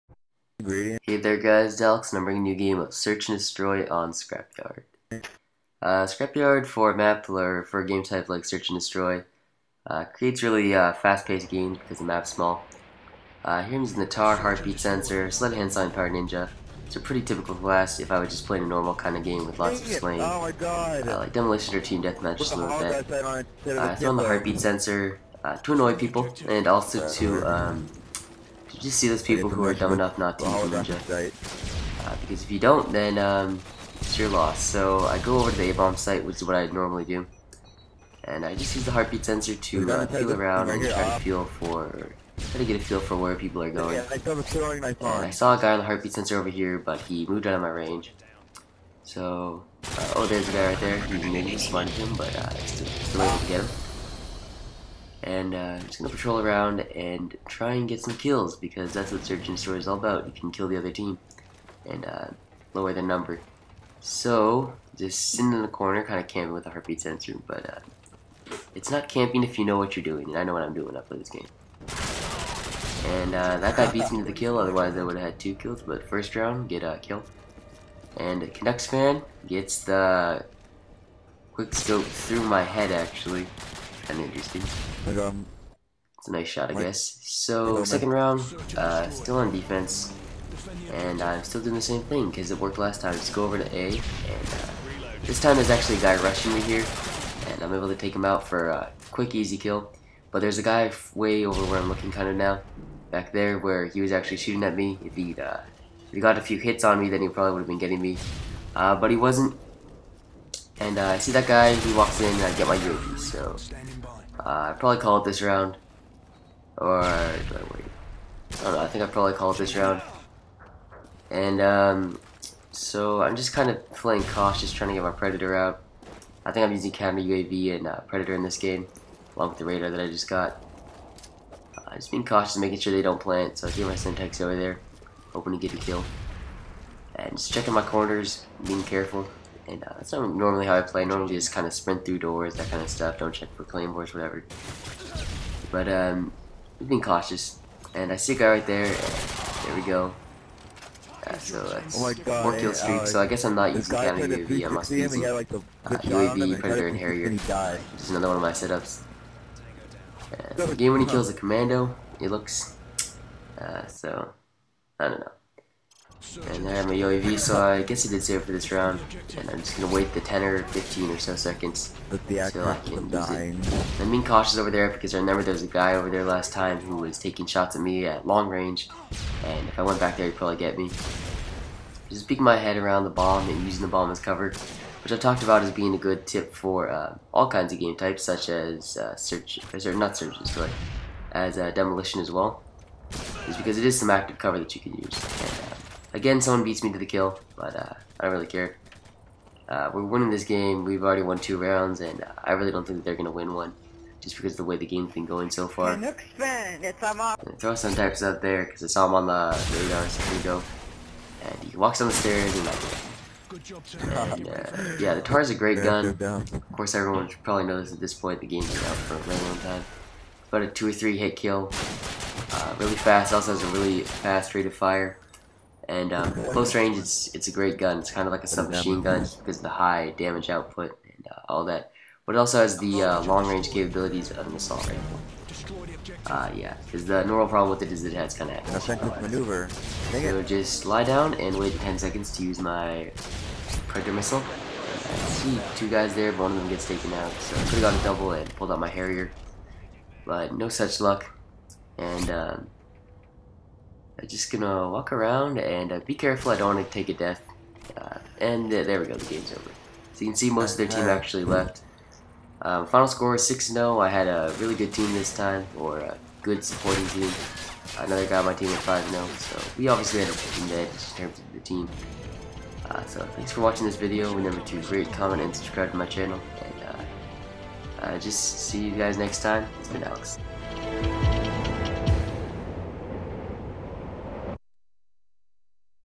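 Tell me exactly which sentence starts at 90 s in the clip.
And I'm still doing the same thing, because it worked last time.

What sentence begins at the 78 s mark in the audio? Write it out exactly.
And Canucks fan gets the quick scope through my head, actually.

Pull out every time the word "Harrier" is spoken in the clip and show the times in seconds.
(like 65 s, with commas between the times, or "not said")
156 s, 248 s.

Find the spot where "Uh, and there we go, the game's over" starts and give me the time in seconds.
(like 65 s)
257 s.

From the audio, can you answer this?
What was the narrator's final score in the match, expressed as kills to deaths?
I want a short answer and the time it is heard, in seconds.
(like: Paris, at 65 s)
6-0, at 263 s.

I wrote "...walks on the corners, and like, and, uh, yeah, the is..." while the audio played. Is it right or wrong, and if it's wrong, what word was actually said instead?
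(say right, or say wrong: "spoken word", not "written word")
wrong: "stairs", not "corners".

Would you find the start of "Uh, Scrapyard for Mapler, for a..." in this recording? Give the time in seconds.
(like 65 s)
5 s.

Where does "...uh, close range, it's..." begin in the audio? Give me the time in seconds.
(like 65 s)
226 s.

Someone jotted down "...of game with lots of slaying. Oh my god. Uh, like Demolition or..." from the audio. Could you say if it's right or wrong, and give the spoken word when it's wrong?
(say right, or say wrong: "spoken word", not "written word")
right.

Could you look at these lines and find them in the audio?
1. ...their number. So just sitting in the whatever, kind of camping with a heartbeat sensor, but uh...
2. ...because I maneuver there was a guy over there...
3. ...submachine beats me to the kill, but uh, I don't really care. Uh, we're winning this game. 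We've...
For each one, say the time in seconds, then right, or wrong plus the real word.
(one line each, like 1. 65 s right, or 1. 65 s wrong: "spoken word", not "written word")
1. 62 s wrong: "corner", not "whatever"
2. 174 s wrong: "remember", not "maneuver"
3. 196 s wrong: "someone", not "submachine".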